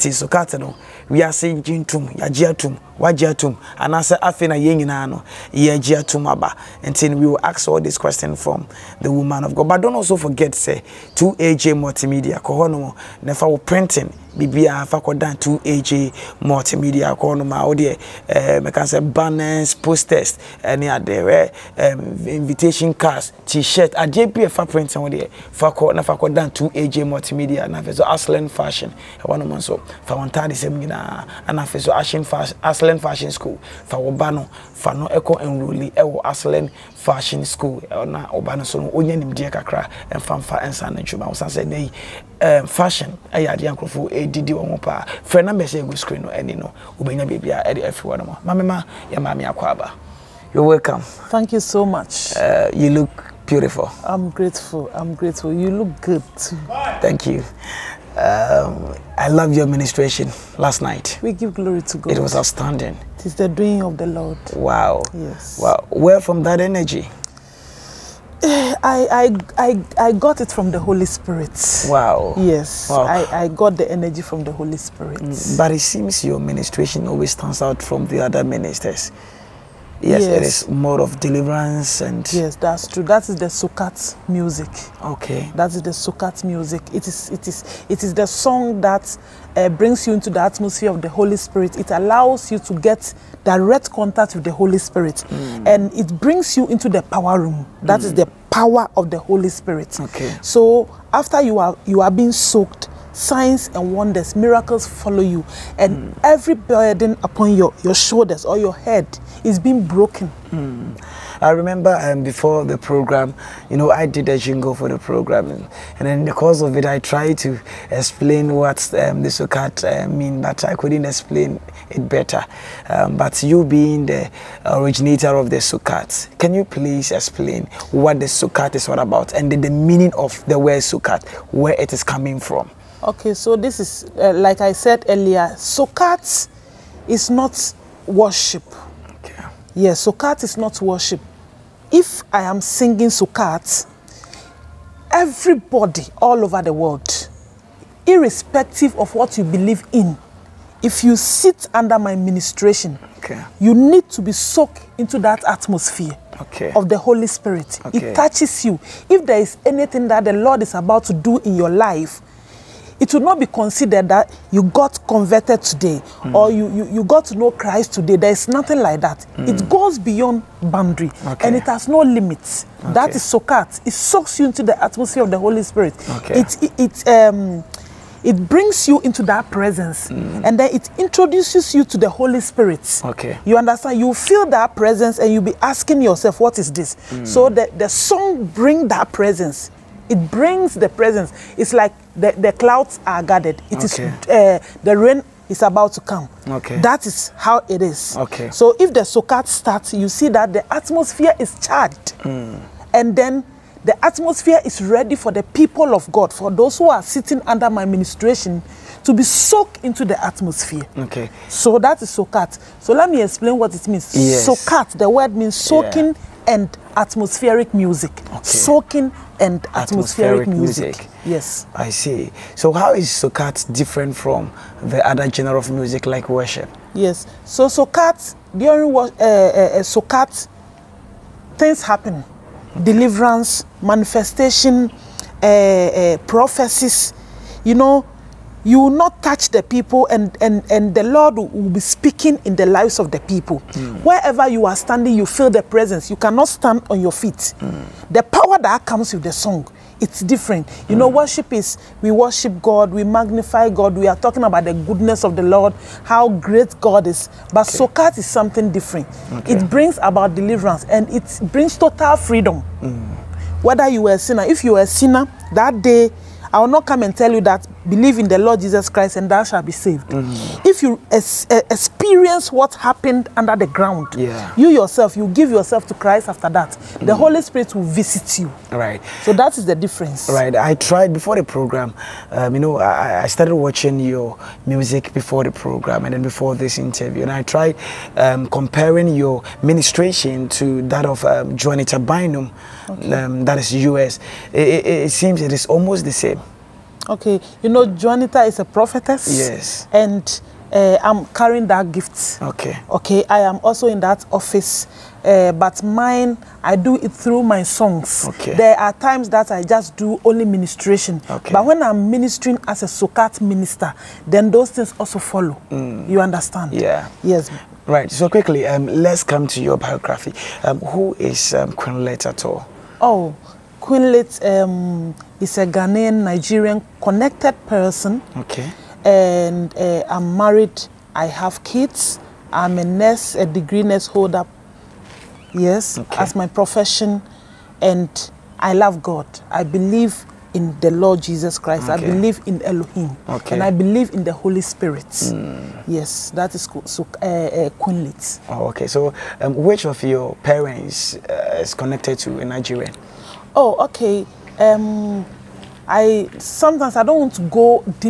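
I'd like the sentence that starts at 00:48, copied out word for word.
ma mamema yɛ maame akɔ aba You're welcome.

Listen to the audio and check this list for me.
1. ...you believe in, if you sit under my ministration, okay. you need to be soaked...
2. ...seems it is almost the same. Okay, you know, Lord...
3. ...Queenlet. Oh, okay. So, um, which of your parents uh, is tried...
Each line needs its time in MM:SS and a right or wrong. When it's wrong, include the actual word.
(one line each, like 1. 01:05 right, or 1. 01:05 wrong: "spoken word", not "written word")
1. 02:29 right
2. 04:55 wrong: "Juanita", not "Lord"
3. 05:47 wrong: "connected", not "tried".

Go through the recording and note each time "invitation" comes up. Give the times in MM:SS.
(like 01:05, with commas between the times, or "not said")
00:22.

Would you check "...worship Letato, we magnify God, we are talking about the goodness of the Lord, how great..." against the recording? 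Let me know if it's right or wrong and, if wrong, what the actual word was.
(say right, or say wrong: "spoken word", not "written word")
wrong: "God", not "Letato".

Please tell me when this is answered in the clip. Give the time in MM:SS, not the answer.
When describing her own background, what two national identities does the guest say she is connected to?
05:25.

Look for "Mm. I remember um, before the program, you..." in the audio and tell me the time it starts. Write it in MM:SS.
01:50.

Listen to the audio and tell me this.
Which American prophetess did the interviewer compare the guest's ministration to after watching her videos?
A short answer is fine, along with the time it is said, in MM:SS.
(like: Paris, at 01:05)
Juanita Bynum, at 04:51.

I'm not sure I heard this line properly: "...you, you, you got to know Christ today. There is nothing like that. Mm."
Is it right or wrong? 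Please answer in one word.
right.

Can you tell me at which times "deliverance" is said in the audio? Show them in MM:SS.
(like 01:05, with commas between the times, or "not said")
01:21, 03:52, 04:20.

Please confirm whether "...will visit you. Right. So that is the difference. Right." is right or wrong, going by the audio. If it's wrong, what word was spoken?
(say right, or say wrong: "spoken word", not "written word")
right.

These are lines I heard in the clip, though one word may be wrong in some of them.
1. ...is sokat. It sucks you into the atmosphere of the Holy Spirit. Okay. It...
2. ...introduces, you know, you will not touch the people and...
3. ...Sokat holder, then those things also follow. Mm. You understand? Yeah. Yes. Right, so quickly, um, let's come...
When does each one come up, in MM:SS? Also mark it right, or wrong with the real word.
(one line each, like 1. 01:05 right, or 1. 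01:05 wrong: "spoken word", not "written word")
1. 02:53 right
2. 03:56 wrong: "prophecies", not "introduces"
3. 05:12 wrong: "minister", not "holder".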